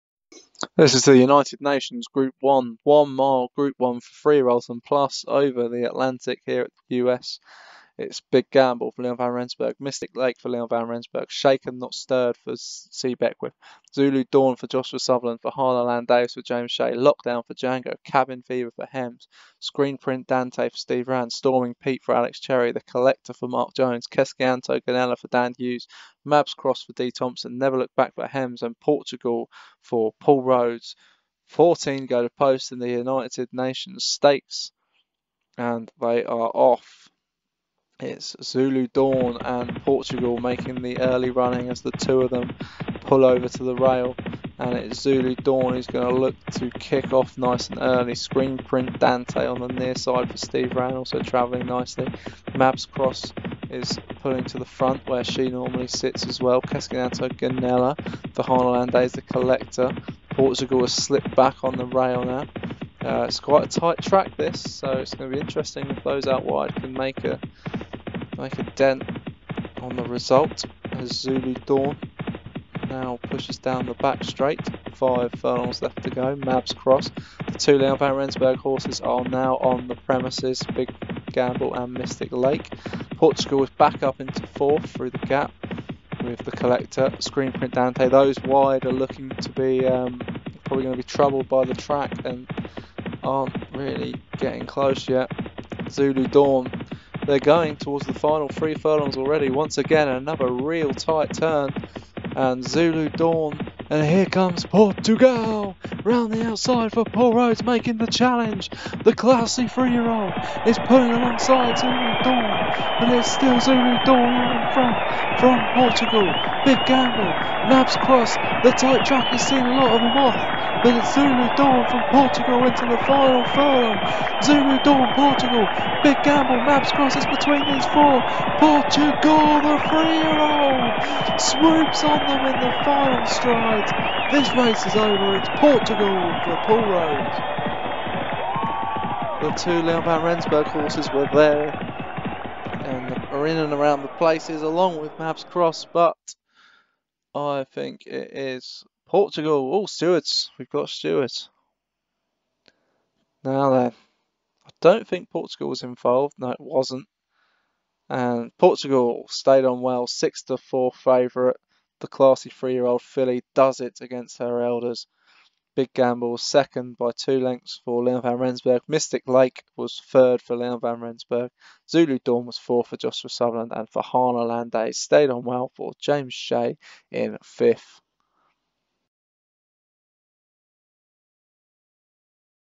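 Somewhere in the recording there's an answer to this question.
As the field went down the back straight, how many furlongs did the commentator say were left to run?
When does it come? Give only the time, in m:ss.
1:14.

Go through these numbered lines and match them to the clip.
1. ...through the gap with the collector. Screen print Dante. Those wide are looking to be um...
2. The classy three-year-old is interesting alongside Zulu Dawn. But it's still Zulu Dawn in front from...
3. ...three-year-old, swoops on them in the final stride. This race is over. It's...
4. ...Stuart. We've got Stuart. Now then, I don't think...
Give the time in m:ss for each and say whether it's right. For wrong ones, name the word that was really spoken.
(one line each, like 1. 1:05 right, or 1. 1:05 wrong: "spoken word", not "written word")
1. 1:24 right
2. 1:49 wrong: "pulling", not "interesting"
3. 2:09 right
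4. 2:29 right.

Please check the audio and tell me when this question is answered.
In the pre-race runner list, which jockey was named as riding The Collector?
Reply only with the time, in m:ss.
0:23.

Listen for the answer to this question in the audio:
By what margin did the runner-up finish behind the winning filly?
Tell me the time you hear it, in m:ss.
2:47.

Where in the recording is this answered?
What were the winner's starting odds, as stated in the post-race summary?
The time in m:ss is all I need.
2:40.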